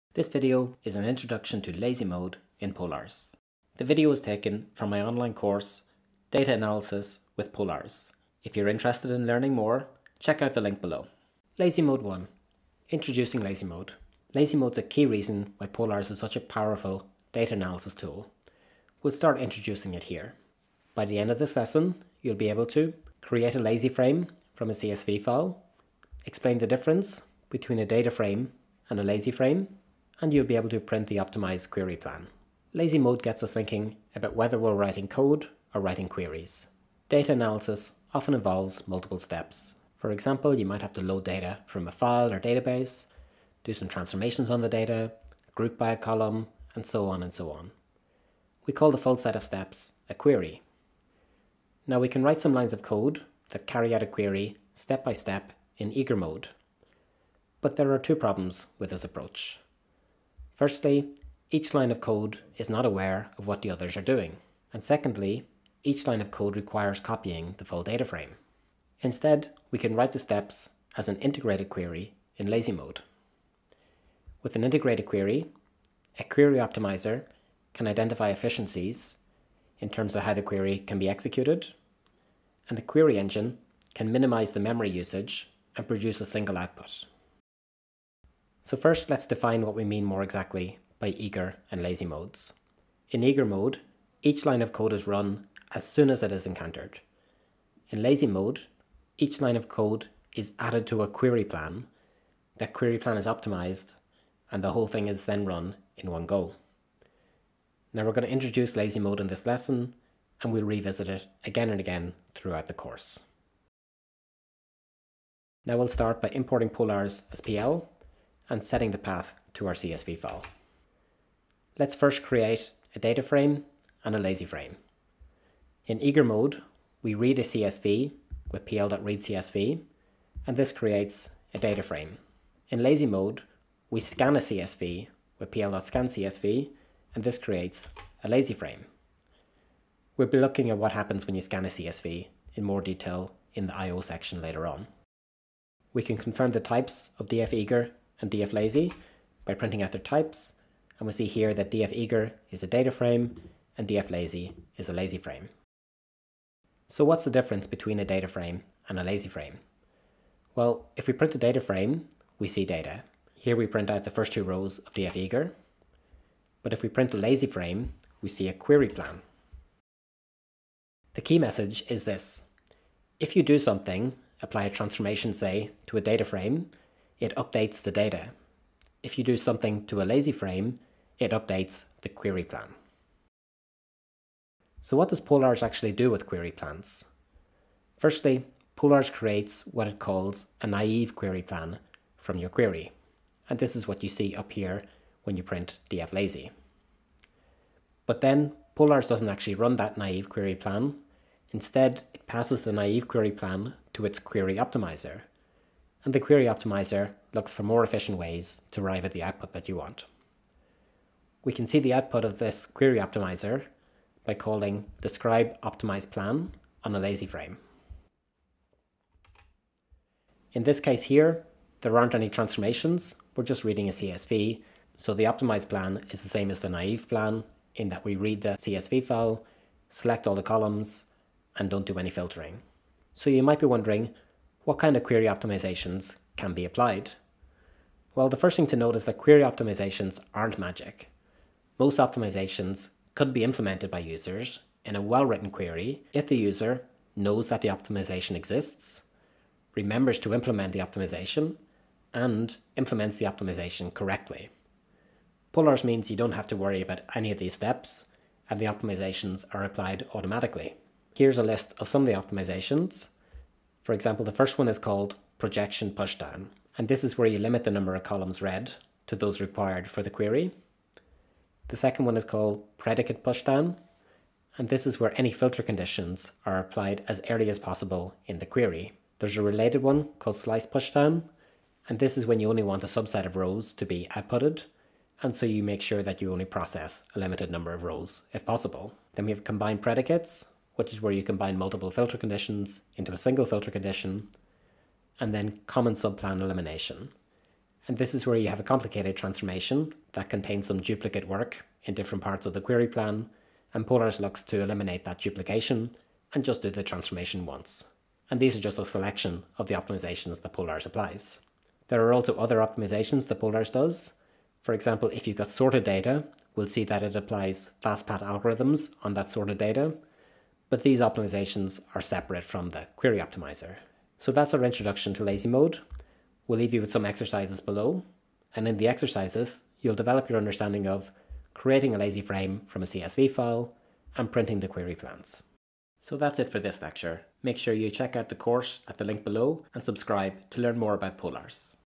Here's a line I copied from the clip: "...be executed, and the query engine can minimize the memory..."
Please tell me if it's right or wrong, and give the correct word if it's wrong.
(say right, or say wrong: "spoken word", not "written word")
right.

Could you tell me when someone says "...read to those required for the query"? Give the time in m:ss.
4:28.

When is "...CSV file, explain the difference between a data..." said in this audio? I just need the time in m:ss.
0:24.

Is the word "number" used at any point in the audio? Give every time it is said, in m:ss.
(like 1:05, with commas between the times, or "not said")
4:27, 4:47.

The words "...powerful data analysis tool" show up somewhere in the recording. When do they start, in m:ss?
0:16.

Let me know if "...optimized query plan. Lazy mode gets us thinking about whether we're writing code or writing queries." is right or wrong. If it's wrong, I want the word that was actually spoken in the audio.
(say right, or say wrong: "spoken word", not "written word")
right.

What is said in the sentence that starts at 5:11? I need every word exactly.
There are also other optimizations that Polars does.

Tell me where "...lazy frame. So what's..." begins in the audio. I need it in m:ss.
2:34.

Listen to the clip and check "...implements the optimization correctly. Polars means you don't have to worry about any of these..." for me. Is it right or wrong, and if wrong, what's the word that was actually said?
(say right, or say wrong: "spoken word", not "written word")
right.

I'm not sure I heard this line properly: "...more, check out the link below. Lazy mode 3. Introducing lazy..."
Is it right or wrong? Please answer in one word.
wrong.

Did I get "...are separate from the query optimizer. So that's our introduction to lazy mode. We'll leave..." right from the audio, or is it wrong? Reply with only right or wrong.
right.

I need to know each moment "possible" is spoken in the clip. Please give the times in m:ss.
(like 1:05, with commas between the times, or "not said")
4:37, 4:48.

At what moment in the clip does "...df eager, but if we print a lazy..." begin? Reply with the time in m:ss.
2:44.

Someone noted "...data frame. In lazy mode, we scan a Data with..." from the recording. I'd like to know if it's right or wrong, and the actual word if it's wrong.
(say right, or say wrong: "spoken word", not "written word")
wrong: "CSV", not "Data".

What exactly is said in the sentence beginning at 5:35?
So that's it for this lecture.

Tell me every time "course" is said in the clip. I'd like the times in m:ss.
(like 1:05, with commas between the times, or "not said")
0:05, 1:52, 5:38.